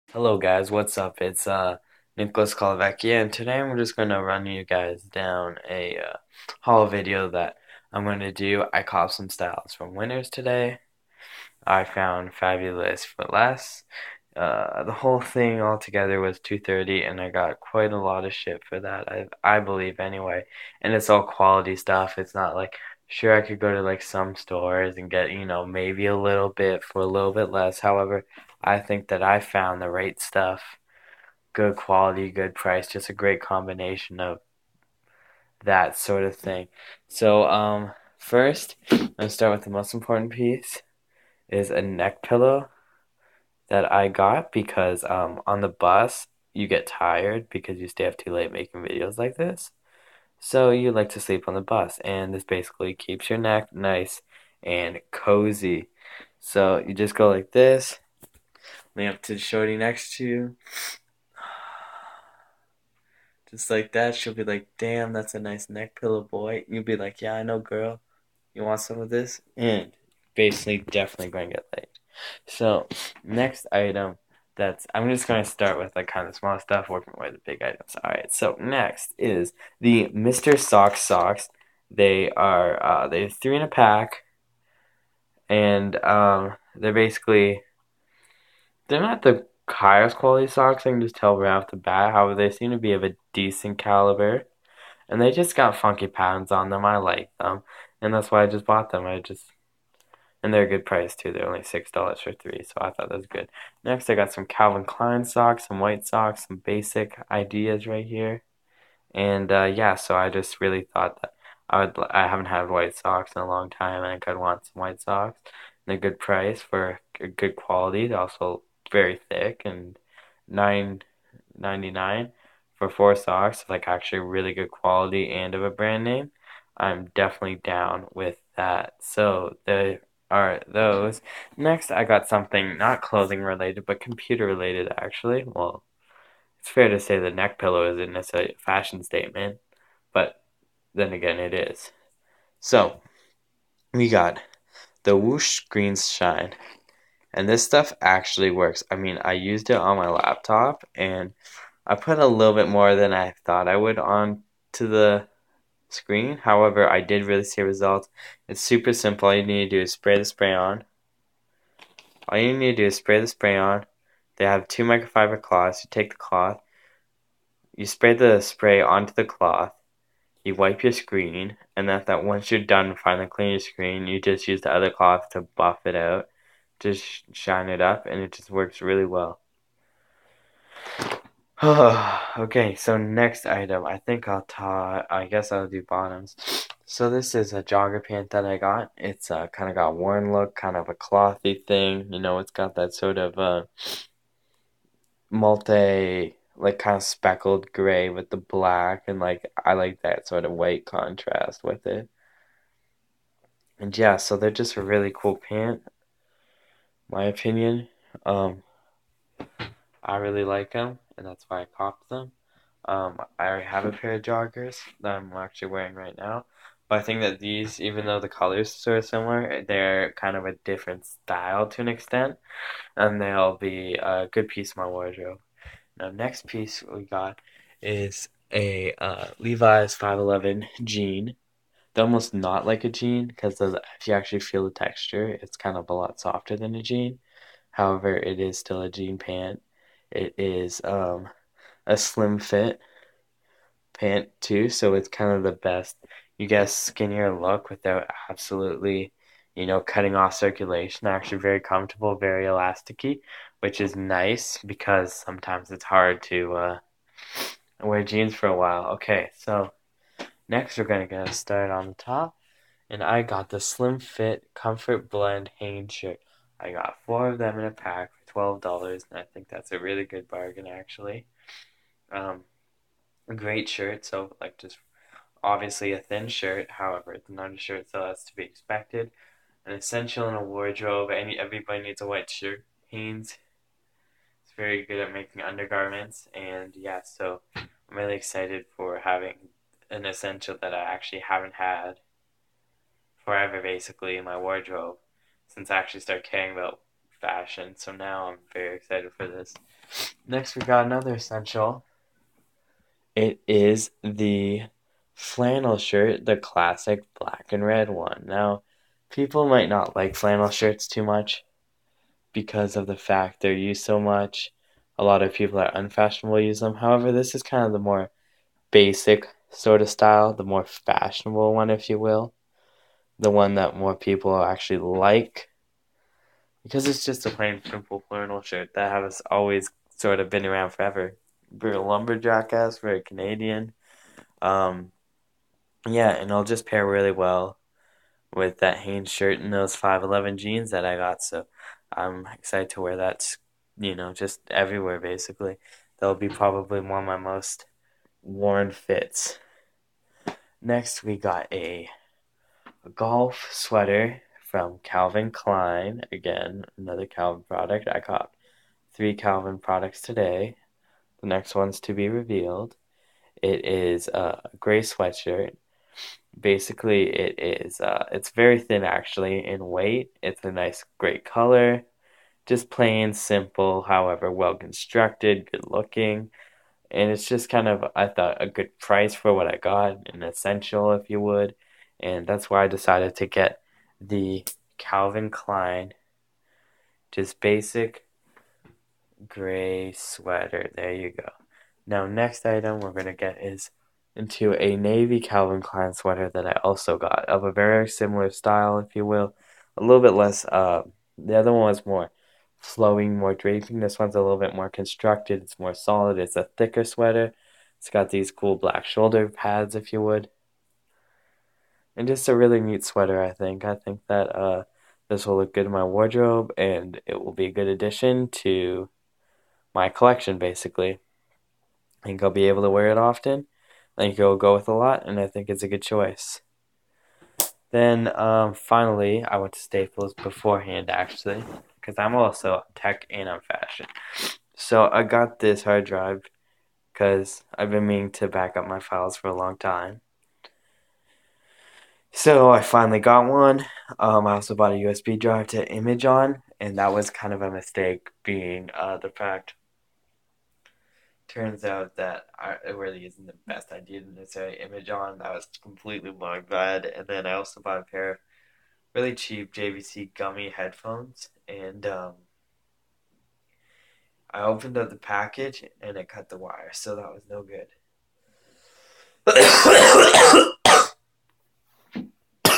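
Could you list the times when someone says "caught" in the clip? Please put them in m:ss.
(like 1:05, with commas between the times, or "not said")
0:08, 5:57.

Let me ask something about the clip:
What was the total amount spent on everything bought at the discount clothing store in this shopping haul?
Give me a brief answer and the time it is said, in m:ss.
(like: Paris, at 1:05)
230, at 0:16.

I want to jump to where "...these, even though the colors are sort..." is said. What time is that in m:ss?
3:37.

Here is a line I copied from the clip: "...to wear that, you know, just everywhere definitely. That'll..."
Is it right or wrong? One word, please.
wrong.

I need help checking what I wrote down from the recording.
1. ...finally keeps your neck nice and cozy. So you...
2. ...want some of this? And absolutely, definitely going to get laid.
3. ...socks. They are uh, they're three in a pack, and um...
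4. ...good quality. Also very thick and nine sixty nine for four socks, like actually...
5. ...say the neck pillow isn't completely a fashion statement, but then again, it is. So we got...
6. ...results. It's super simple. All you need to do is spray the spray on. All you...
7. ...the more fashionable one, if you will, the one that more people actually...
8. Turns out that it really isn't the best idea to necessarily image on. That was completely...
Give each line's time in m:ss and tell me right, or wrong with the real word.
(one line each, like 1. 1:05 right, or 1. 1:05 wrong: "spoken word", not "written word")
1. 0:52 wrong: "basically", not "finally"
2. 1:08 wrong: "basically", not "absolutely"
3. 1:20 right
4. 1:57 wrong: "ninety", not "sixty"
5. 2:16 wrong: "necessarily", not "completely"
6. 2:37 right
7. 5:20 right
8. 7:31 right.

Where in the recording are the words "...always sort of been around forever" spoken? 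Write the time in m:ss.
5:29.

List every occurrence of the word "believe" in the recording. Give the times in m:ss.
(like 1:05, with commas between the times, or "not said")
0:19.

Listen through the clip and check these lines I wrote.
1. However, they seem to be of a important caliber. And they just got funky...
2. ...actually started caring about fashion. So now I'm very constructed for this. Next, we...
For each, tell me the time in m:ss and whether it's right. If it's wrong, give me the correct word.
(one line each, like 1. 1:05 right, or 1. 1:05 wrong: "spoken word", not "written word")
1. 1:32 wrong: "decent", not "important"
2. 4:55 wrong: "excited", not "constructed".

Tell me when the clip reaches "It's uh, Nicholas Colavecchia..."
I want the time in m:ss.
0:01.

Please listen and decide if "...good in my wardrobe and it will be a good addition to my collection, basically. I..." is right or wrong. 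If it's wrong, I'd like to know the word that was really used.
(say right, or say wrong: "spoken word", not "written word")
right.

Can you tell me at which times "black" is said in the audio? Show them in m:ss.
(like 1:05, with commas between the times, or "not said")
3:18, 5:07, 6:48.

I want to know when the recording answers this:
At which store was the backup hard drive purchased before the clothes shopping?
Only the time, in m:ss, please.
7:09.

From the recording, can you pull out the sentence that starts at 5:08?
Now, people might not like flannel shirts too much because of the fact they're used so much.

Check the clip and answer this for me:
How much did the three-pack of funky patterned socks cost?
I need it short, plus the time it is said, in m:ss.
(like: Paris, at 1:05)
$6, at 1:41.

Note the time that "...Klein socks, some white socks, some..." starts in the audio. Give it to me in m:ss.
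1:44.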